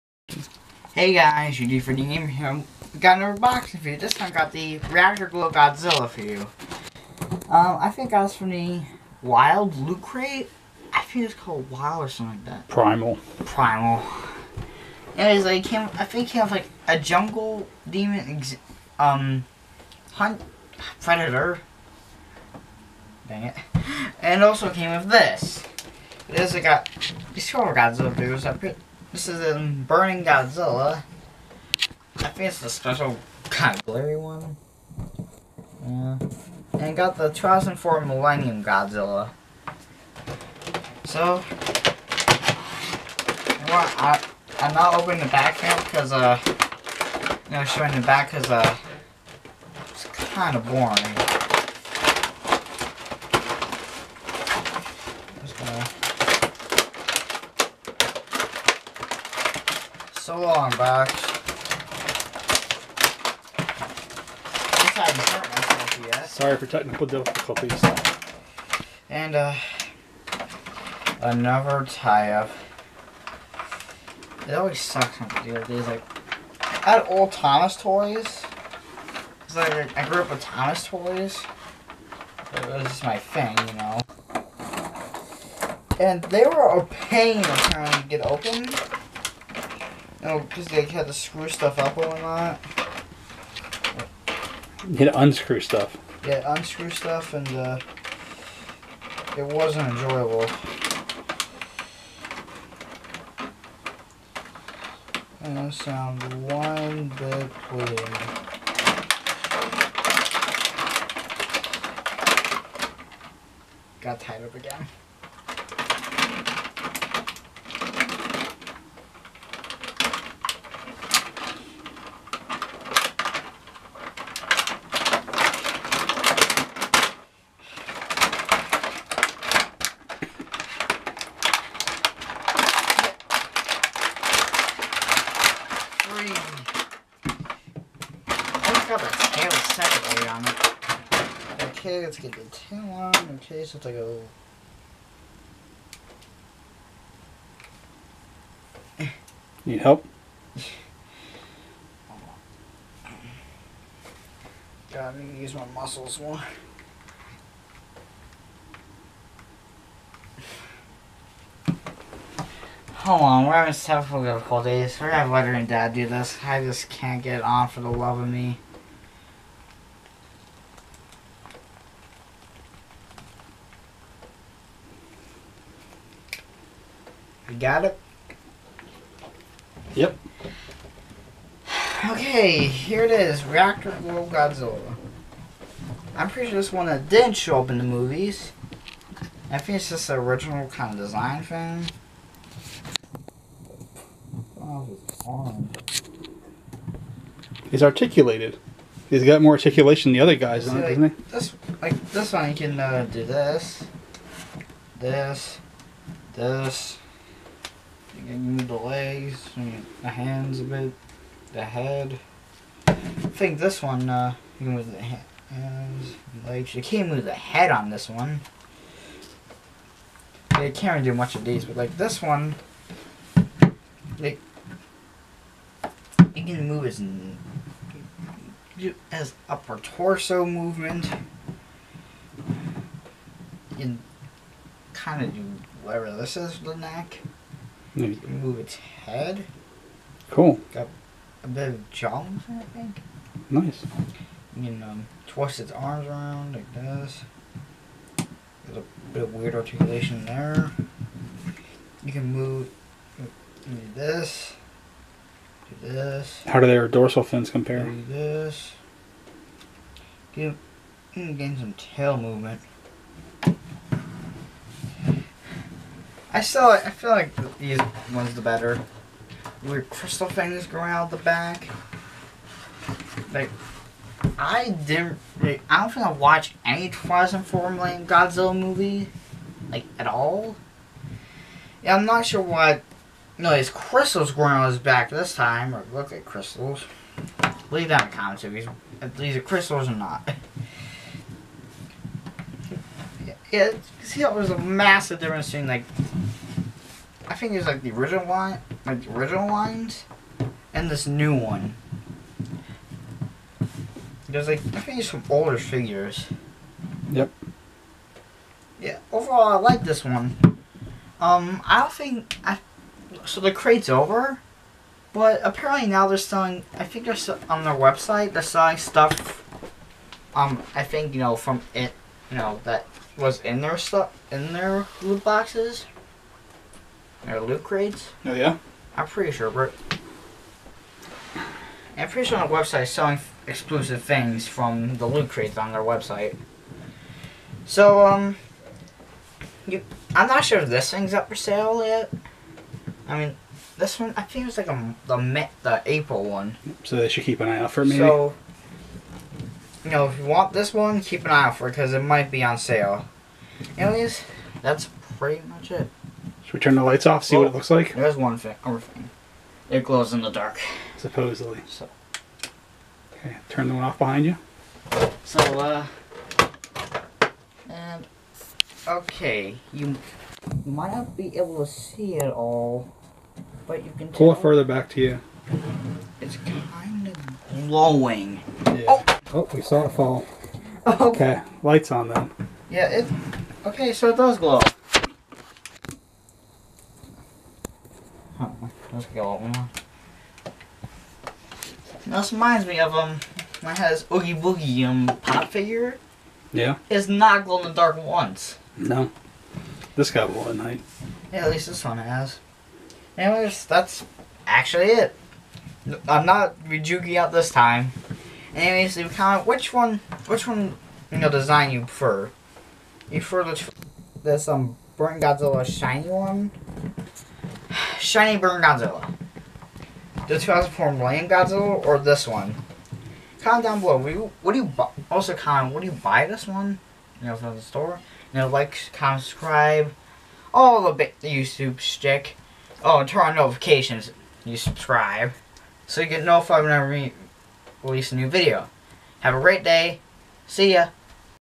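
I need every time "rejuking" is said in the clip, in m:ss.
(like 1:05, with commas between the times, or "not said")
6:46.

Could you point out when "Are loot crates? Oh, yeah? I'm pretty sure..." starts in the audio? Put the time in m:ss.
5:27.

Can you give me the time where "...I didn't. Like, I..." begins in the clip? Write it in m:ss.
4:34.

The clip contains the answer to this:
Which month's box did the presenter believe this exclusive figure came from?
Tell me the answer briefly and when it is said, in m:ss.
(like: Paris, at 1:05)
April, at 5:45.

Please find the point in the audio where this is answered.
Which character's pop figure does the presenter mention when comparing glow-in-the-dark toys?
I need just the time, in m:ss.
6:34.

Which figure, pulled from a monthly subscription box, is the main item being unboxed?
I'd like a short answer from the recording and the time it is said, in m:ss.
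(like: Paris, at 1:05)
Reactor Glow Godzilla, at 0:04.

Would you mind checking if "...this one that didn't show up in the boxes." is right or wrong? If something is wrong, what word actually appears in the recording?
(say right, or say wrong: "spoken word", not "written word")
wrong: "movies", not "boxes".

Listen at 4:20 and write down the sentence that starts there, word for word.
Give, mm, gain some tail movement.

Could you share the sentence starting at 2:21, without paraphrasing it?
Okay, let's get the tail on.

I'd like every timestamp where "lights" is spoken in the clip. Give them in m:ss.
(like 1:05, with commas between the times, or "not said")
5:56, 6:21.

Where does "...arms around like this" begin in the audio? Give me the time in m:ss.
4:05.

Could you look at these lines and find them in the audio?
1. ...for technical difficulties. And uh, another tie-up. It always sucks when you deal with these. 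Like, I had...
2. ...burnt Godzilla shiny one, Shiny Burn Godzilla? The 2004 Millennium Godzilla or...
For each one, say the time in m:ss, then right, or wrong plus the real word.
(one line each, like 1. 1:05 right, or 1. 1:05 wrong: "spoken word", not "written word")
1. 1:06 right
2. 6:54 right.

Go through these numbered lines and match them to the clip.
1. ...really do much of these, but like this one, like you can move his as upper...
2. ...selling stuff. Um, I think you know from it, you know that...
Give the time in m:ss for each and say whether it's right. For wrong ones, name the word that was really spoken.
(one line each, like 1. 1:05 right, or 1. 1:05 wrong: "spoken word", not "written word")
1. 3:40 right
2. 5:18 right.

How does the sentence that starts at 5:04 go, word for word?
There's like I think there's some older figures.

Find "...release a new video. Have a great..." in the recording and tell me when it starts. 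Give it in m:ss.
7:17.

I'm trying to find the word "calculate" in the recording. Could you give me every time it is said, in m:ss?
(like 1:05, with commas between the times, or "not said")
not said.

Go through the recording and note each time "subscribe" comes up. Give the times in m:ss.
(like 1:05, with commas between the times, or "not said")
7:09, 7:14.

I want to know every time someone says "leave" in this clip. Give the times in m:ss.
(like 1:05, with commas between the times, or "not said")
4:47, 6:48.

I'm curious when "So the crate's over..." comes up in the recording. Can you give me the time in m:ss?
5:13.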